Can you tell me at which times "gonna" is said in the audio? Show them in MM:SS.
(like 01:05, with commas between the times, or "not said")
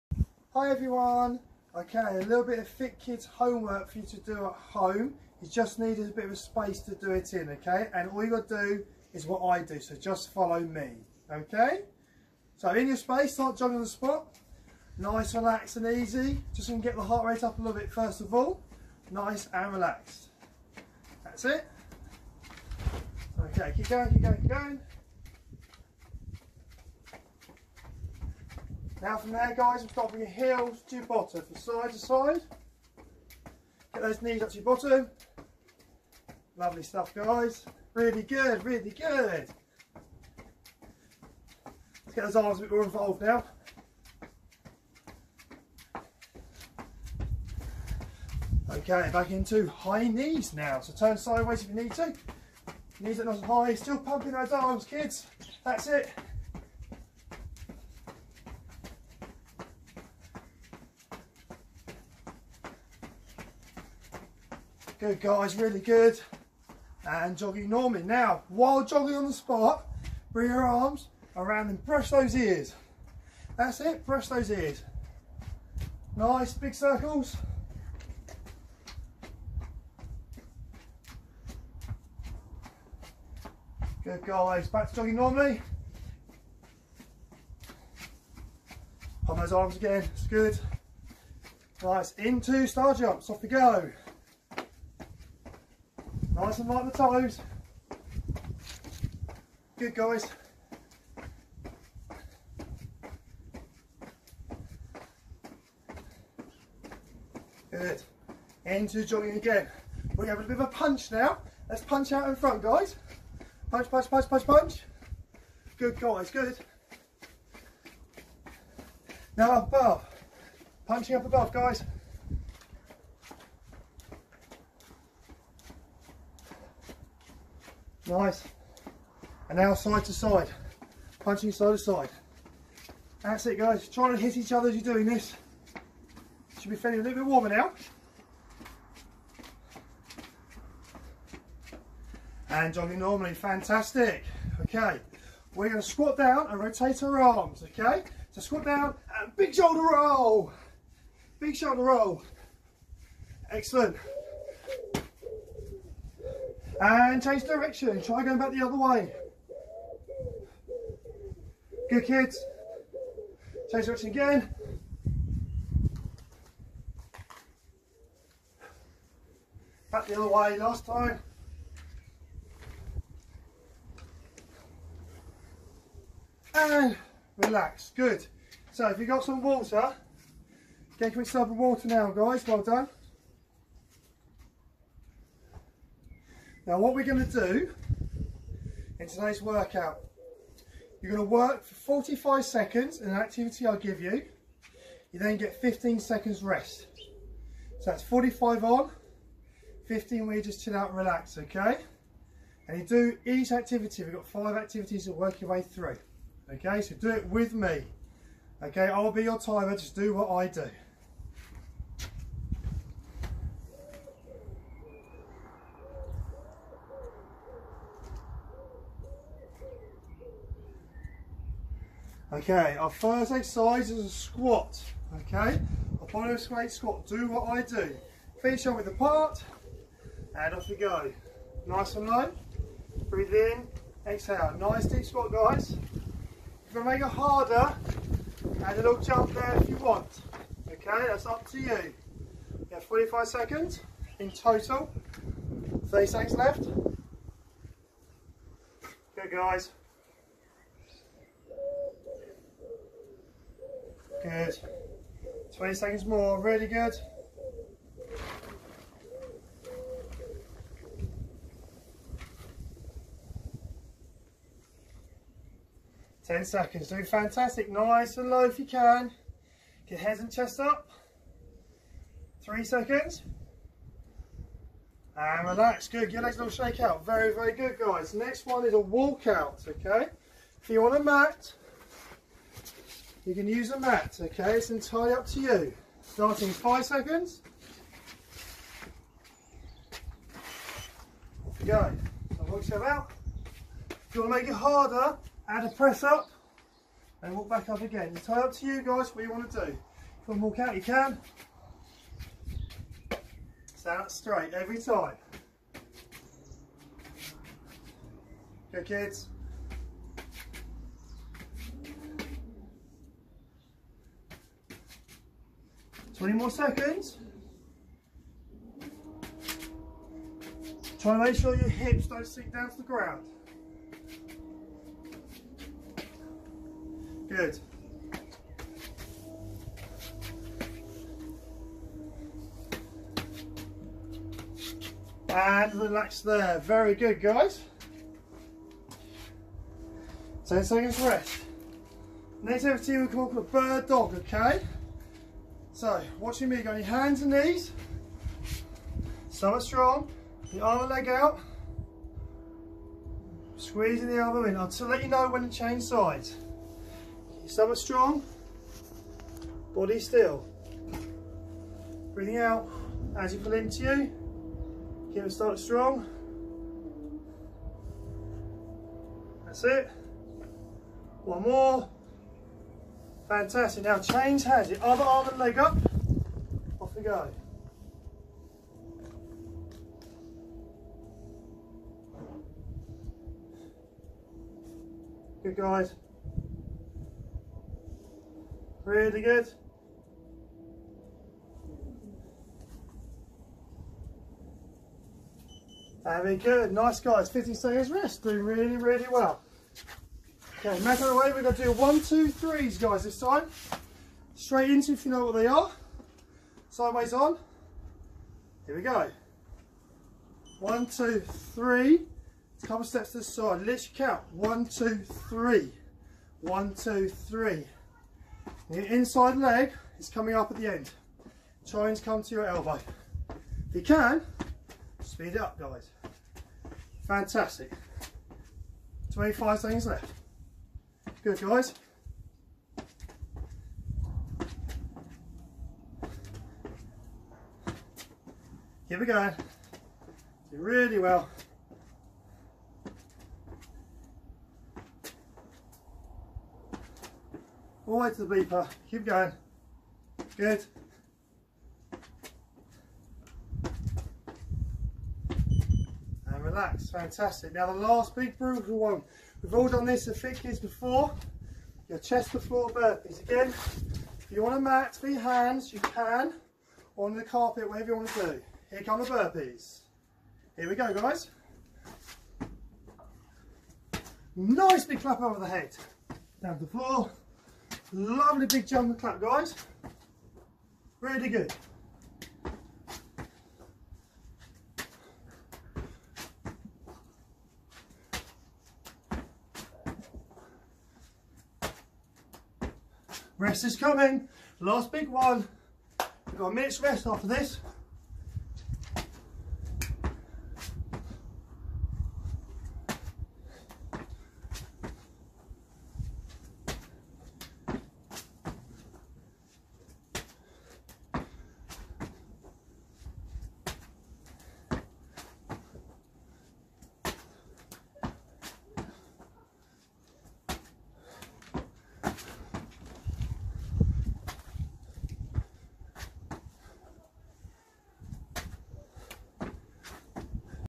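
00:16, 02:25.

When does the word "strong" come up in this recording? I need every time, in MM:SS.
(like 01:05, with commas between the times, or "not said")
05:49, 05:57, 06:05.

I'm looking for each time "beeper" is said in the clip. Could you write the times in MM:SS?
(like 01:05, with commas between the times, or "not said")
07:28.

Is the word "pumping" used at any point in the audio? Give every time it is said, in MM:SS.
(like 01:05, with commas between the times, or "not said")
00:53.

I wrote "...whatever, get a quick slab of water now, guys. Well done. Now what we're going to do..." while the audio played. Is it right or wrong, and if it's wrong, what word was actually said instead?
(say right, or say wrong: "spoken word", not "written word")
wrong: "water", not "whatever".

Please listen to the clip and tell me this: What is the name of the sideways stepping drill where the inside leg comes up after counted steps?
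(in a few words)
one, two, threes.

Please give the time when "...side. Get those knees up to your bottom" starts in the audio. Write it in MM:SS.
00:31.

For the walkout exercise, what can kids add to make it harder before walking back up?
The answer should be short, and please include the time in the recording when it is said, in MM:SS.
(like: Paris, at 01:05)
press up, at 04:55.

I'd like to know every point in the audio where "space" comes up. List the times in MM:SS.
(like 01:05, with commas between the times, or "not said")
00:06, 00:12.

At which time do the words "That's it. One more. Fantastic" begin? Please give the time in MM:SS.
06:09.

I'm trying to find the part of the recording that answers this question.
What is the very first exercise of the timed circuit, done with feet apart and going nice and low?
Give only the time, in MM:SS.
03:46.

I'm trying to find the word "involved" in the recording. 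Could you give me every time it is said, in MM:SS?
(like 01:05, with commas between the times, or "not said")
00:42.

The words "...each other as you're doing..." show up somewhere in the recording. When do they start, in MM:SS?
02:14.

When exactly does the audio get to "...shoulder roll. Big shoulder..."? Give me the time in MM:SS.
02:29.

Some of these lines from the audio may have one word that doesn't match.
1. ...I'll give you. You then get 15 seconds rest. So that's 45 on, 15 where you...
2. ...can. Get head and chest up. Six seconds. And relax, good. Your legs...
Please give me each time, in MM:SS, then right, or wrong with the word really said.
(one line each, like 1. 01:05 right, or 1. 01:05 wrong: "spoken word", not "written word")
1. 03:13 right
2. 04:28 wrong: "Three", not "Six".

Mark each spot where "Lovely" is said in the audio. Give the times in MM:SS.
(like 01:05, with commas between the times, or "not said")
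00:36, 07:57.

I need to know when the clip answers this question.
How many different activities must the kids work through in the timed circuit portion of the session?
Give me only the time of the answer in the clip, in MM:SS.
03:24.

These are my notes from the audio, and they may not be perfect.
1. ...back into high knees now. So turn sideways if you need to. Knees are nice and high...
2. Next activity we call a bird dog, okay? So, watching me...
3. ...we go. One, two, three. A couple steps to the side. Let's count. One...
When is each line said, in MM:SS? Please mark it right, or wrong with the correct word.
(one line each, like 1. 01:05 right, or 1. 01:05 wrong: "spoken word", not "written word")
1. 00:49 right
2. 05:42 right
3. 06:48 right.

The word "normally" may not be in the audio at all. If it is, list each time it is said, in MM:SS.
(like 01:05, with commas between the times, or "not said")
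01:07, 01:25, 02:22.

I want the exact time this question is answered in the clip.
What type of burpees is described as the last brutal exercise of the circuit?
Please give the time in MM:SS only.
07:41.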